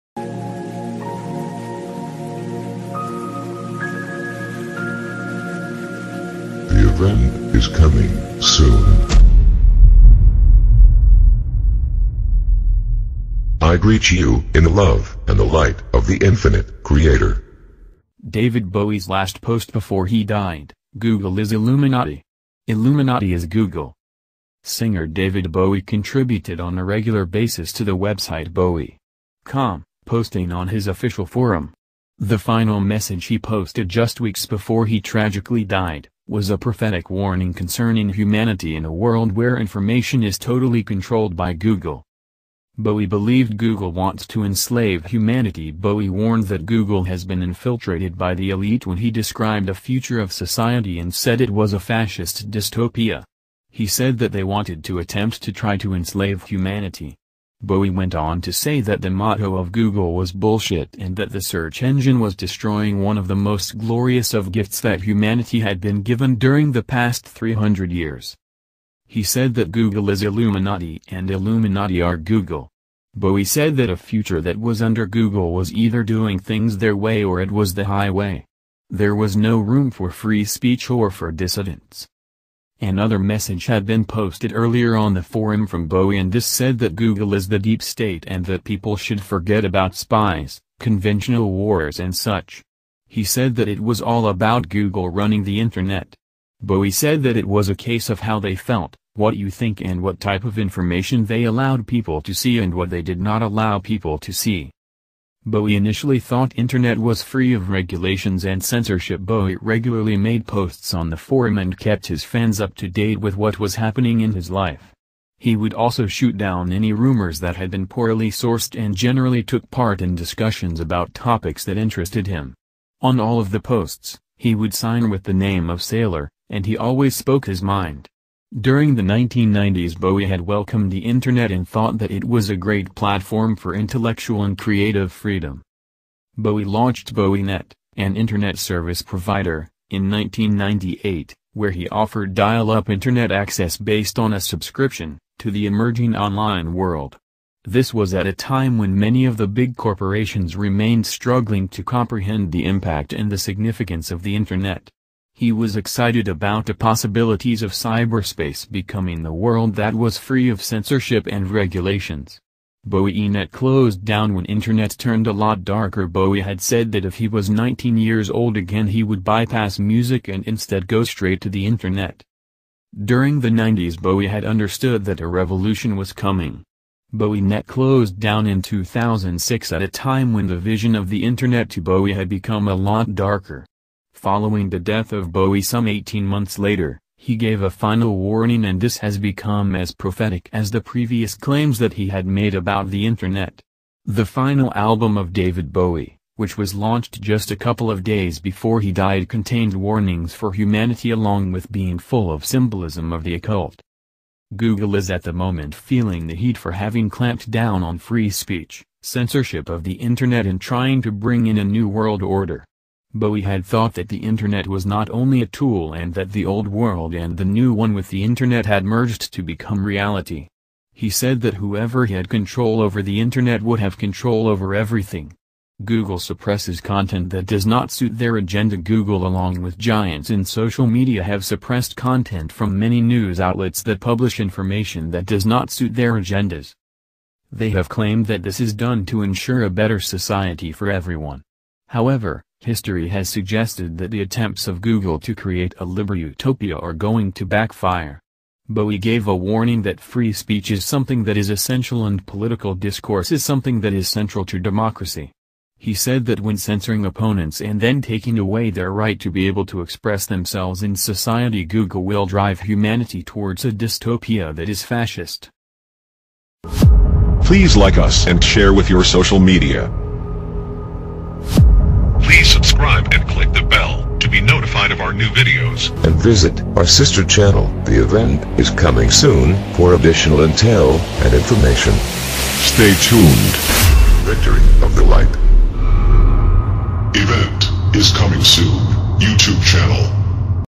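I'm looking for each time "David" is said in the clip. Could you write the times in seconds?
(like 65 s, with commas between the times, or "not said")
18 s, 25 s, 195 s.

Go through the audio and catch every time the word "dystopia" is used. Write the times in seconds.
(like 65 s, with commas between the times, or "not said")
52 s, 263 s.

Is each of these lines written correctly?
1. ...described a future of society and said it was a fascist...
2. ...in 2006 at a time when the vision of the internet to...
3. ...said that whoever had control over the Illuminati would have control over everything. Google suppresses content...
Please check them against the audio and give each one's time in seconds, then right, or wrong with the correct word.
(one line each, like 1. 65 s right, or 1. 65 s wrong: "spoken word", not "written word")
1. 49 s right
2. 178 s right
3. 221 s wrong: "Internet", not "Illuminati".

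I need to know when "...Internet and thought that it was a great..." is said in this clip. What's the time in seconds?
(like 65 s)
131 s.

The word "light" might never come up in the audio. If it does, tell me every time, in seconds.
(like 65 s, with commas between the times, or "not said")
15 s, 285 s.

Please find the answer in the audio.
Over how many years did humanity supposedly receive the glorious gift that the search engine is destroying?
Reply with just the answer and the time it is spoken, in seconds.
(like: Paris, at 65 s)
300, at 67 s.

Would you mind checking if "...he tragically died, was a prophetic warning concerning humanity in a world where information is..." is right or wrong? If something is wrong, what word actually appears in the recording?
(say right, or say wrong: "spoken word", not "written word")
right.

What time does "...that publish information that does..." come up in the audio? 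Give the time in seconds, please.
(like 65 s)
233 s.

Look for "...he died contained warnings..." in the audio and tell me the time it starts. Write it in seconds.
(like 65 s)
198 s.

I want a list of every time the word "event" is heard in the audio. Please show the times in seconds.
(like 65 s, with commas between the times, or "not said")
278 s, 287 s.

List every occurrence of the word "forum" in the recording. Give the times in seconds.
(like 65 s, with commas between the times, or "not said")
31 s, 85 s, 111 s.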